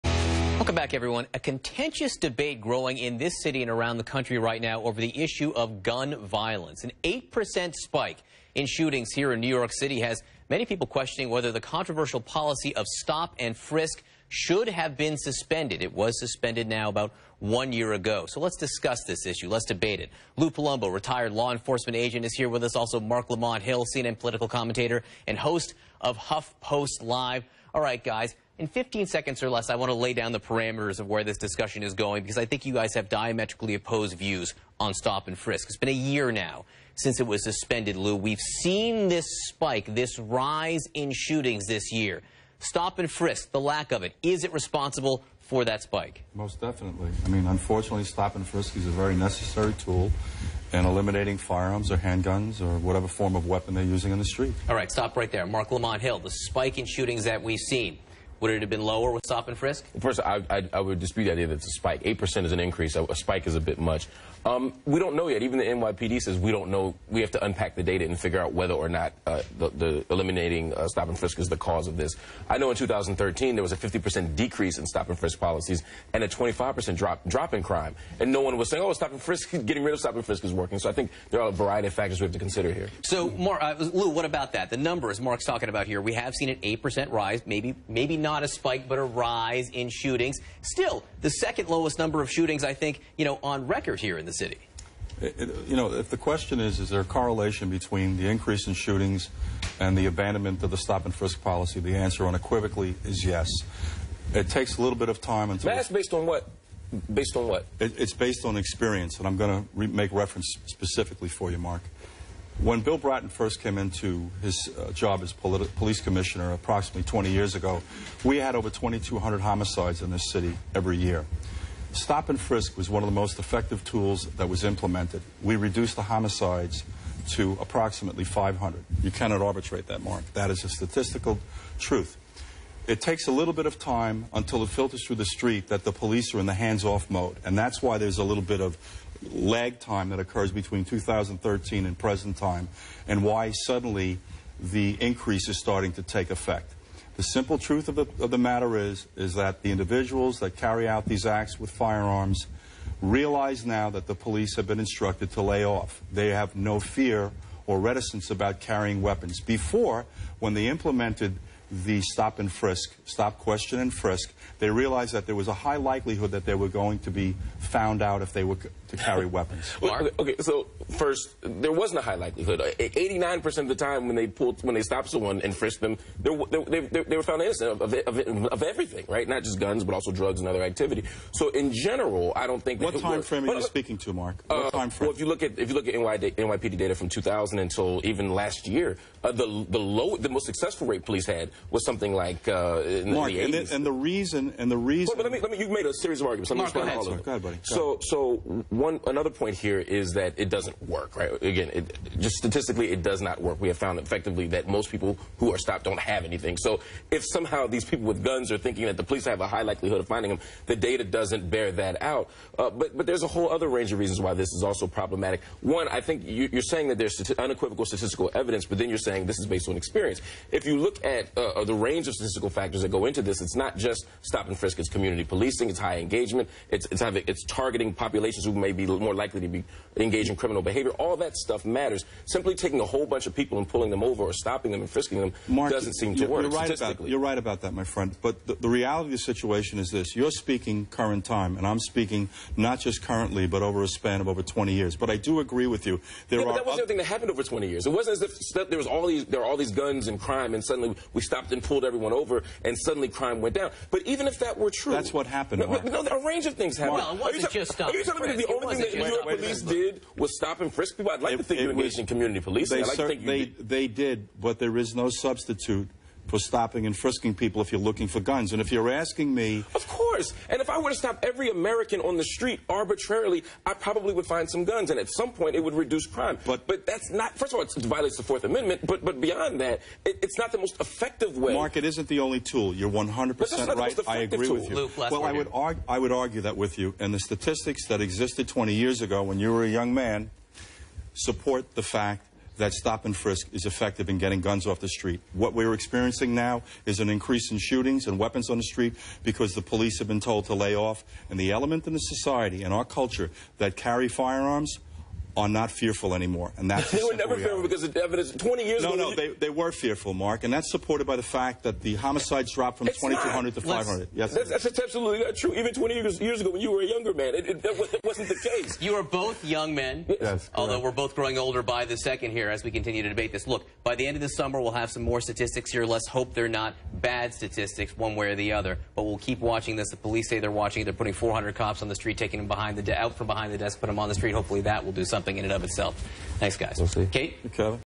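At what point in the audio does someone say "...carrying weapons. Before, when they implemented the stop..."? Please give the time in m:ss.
2:38.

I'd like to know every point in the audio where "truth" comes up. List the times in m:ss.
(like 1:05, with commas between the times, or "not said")
2:11, 2:27.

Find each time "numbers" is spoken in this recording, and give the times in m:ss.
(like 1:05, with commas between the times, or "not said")
1:24, 1:31.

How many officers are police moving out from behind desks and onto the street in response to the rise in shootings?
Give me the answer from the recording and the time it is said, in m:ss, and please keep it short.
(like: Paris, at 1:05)
400, at 5:31.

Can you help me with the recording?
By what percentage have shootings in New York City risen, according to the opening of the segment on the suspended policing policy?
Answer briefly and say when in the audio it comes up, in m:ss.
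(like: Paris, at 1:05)
8%, at 0:07.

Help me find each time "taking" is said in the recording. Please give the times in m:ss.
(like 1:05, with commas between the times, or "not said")
3:52, 5:32.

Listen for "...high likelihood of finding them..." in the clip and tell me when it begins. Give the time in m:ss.
3:29.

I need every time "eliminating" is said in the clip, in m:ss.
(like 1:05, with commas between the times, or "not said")
0:50, 1:10.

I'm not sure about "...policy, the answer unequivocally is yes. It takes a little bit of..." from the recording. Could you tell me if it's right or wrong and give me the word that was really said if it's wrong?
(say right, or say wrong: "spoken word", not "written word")
right.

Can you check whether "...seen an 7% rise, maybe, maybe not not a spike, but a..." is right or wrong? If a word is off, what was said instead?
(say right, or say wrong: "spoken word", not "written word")
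wrong: "8", not "7".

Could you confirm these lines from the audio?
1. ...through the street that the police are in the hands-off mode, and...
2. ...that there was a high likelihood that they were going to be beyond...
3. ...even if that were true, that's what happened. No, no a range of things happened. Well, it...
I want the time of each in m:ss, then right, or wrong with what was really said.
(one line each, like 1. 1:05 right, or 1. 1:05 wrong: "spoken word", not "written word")
1. 2:15 right
2. 2:45 wrong: "found", not "beyond"
3. 4:14 right.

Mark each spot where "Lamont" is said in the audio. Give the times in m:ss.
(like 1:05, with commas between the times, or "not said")
0:23, 0:55.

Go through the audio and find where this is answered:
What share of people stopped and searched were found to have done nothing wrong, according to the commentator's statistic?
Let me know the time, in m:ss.
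2:52.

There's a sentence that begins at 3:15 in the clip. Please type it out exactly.
Well, but let me, let me, you made a series of arguments.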